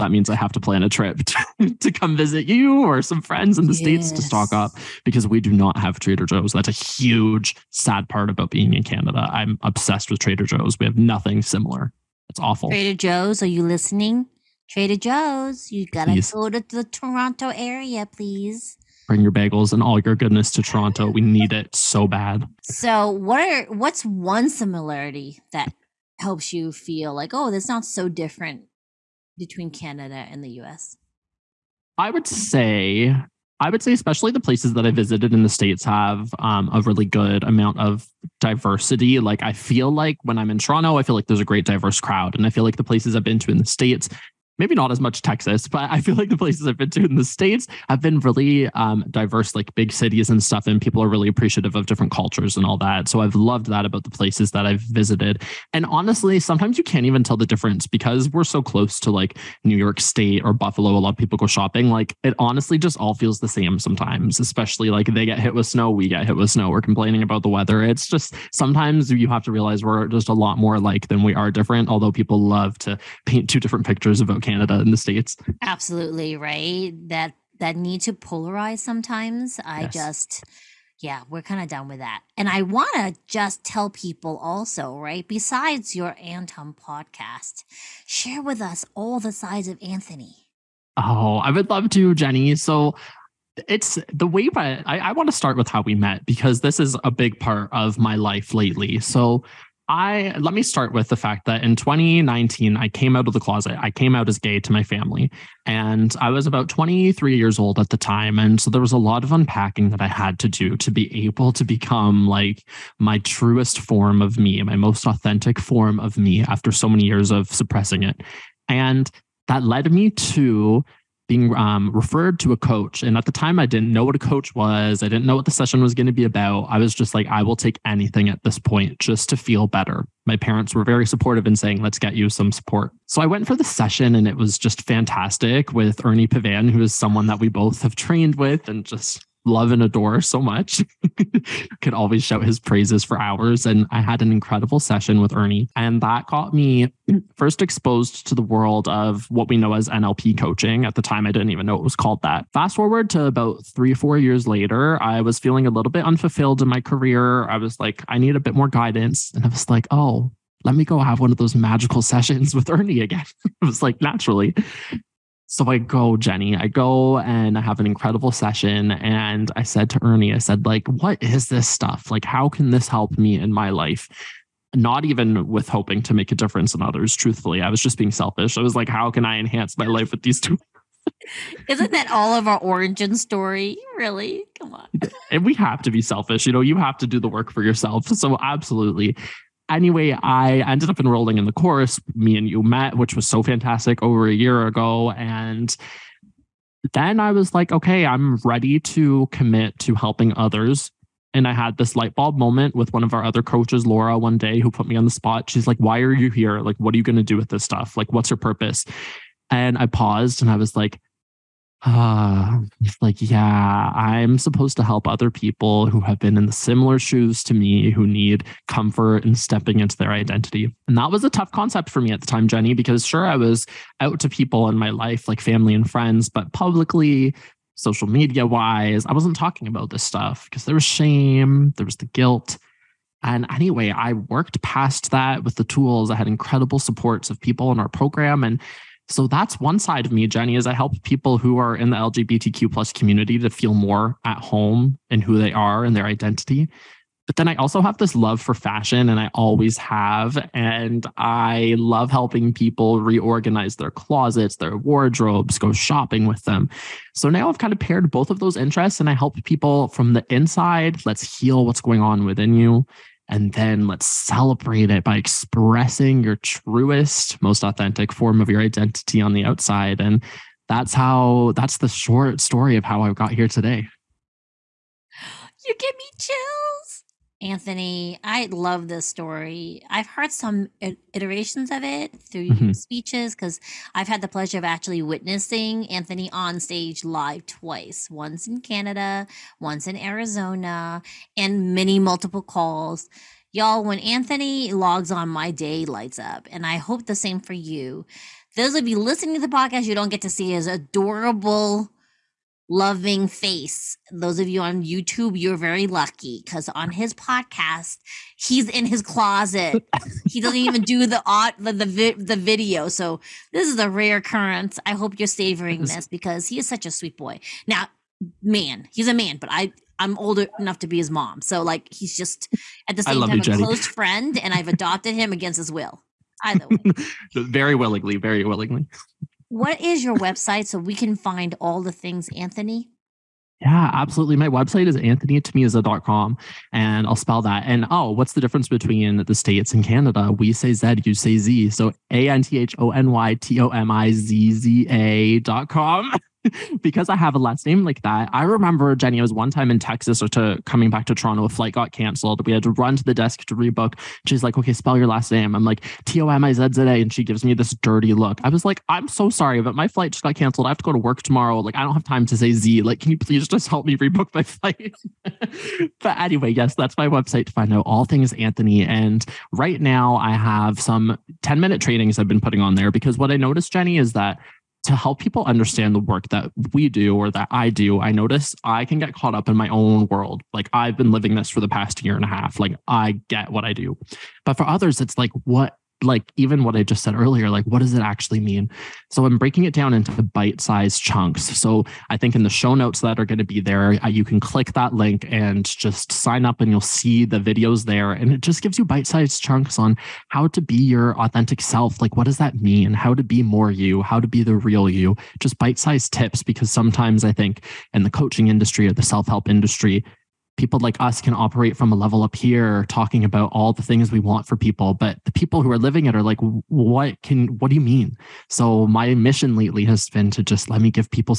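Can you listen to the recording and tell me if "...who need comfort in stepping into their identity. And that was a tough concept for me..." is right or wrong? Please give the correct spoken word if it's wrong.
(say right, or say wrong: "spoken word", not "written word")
right.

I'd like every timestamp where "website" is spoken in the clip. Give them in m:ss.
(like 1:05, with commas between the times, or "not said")
5:30, 5:34, 6:07.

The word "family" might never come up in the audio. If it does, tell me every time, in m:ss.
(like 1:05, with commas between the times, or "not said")
1:44, 3:45.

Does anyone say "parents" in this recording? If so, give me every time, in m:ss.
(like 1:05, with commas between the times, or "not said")
2:10.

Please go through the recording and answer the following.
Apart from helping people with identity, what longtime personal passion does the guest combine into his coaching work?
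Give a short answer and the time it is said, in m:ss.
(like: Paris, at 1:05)
fashion, at 4:08.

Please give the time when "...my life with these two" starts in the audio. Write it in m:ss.
2:59.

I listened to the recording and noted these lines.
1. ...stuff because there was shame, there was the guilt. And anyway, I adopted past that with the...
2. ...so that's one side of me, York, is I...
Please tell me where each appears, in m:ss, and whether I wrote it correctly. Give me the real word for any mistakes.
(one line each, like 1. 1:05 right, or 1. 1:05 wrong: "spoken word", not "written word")
1. 3:50 wrong: "worked", not "adopted"
2. 3:59 wrong: "Jenny", not "York".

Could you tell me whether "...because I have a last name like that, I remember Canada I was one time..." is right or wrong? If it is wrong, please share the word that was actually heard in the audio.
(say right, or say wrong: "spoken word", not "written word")
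wrong: "Jenny", not "Canada".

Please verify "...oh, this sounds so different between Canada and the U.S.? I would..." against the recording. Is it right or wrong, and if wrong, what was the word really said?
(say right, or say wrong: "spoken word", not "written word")
right.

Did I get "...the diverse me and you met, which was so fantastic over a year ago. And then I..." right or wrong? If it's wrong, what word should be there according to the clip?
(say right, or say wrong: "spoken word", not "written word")
wrong: "course", not "diverse".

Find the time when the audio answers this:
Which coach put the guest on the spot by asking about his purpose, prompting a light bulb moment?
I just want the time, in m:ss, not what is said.
3:23.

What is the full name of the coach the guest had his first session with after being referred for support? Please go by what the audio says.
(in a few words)
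Ernie Pavan.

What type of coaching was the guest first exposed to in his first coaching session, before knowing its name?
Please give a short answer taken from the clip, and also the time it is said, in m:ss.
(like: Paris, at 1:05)
NLP coaching, at 2:29.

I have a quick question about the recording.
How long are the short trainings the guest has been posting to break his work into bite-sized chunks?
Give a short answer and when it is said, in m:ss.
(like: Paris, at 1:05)
10 minutes, at 6:11.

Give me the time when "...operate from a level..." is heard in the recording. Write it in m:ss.
6:51.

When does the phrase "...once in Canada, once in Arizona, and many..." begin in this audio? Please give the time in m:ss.
4:48.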